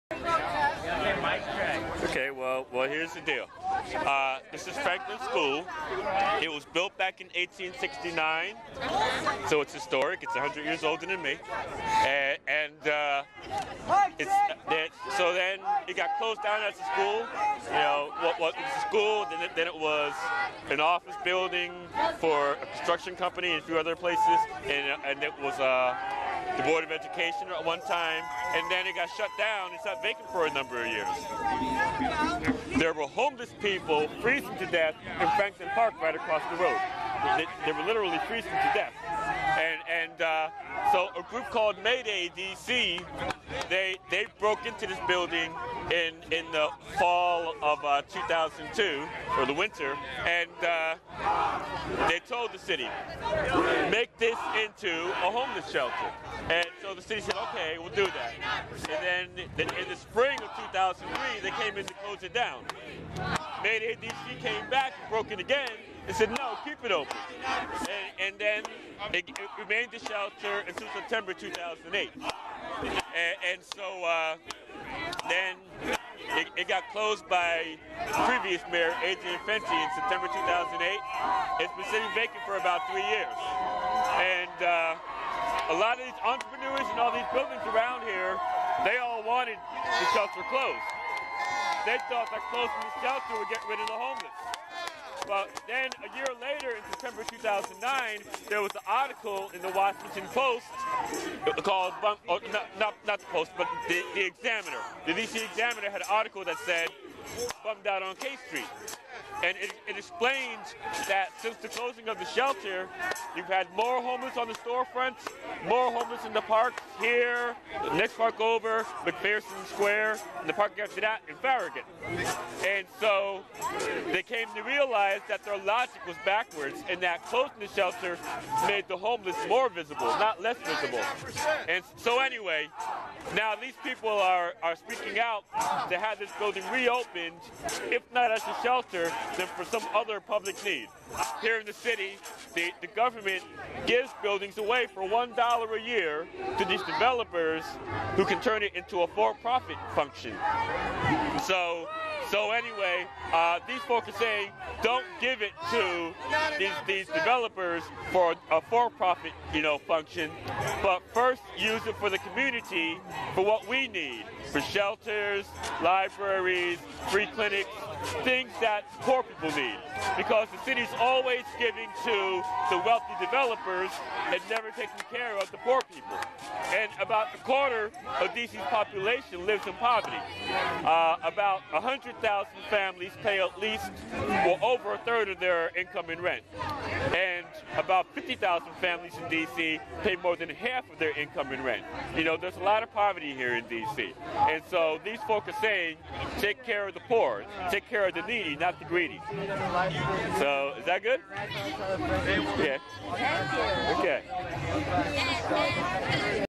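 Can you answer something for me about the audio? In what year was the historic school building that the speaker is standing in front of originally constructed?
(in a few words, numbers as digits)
1869.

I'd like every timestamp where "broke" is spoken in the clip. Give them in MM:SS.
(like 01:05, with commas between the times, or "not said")
00:44, 01:05.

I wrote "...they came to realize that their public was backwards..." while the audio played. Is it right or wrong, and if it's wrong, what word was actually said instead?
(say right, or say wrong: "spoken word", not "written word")
wrong: "logic", not "public".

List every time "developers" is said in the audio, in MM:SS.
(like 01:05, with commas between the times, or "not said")
02:26, 02:37, 02:53.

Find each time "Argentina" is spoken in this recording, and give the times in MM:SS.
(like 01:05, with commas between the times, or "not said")
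not said.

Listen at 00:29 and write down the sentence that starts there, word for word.
It sat vacant for a number of years.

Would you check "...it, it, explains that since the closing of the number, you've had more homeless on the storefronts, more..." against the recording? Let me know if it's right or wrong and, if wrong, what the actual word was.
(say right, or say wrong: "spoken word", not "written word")
wrong: "shelter", not "number".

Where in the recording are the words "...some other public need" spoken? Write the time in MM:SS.
02:19.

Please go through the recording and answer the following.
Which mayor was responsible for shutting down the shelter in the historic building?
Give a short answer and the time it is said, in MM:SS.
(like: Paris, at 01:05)
Adrian Fenty, at 01:19.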